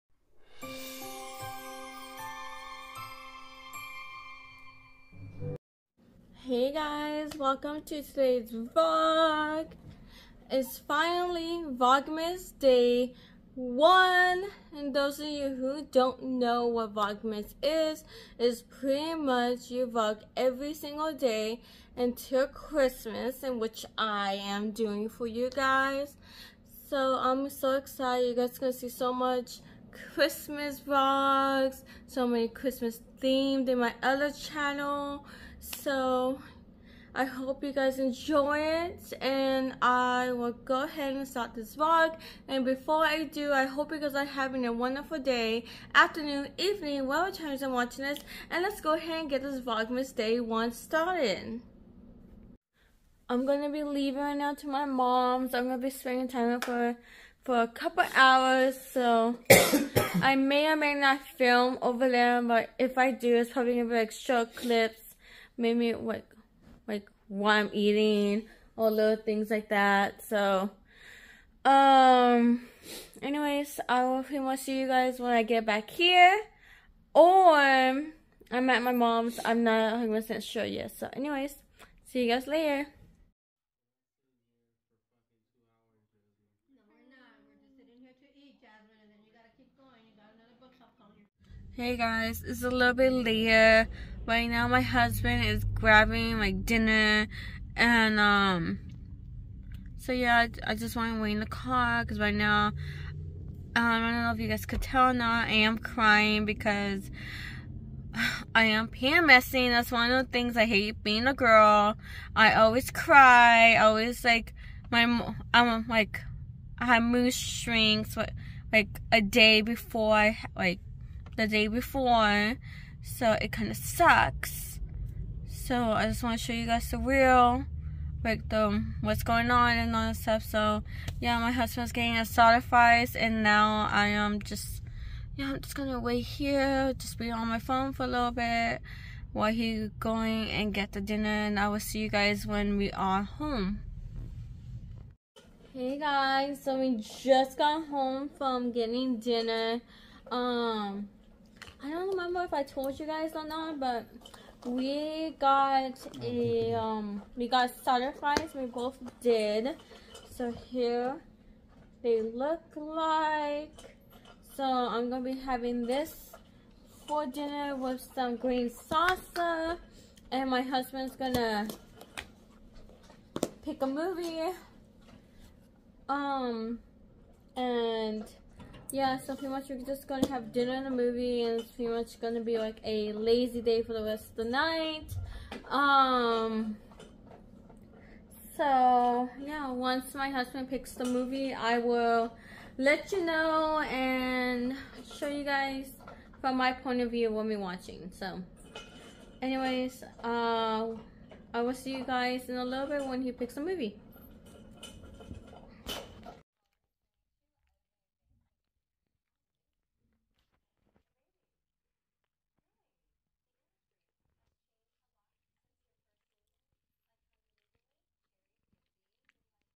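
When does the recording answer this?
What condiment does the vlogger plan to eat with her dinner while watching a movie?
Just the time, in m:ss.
2:48.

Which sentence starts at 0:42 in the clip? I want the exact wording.
And before I do, I hope you guys are having a wonderful day, afternoon, evening, whatever time you're watching this.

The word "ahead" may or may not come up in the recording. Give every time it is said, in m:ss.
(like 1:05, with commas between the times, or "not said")
0:40, 0:48.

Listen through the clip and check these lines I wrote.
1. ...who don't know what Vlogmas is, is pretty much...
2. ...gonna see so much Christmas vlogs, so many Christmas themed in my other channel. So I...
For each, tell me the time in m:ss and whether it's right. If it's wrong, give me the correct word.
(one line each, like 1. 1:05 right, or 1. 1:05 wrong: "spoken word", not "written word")
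1. 0:15 right
2. 0:28 right.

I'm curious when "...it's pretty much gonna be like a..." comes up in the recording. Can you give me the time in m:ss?
3:01.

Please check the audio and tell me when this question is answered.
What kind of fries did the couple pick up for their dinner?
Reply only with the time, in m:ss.
2:37.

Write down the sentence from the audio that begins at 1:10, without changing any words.
So, um, anyways, I will pretty much see you guys when I get back here, or I'm at my mom's.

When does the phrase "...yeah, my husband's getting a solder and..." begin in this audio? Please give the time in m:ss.
2:11.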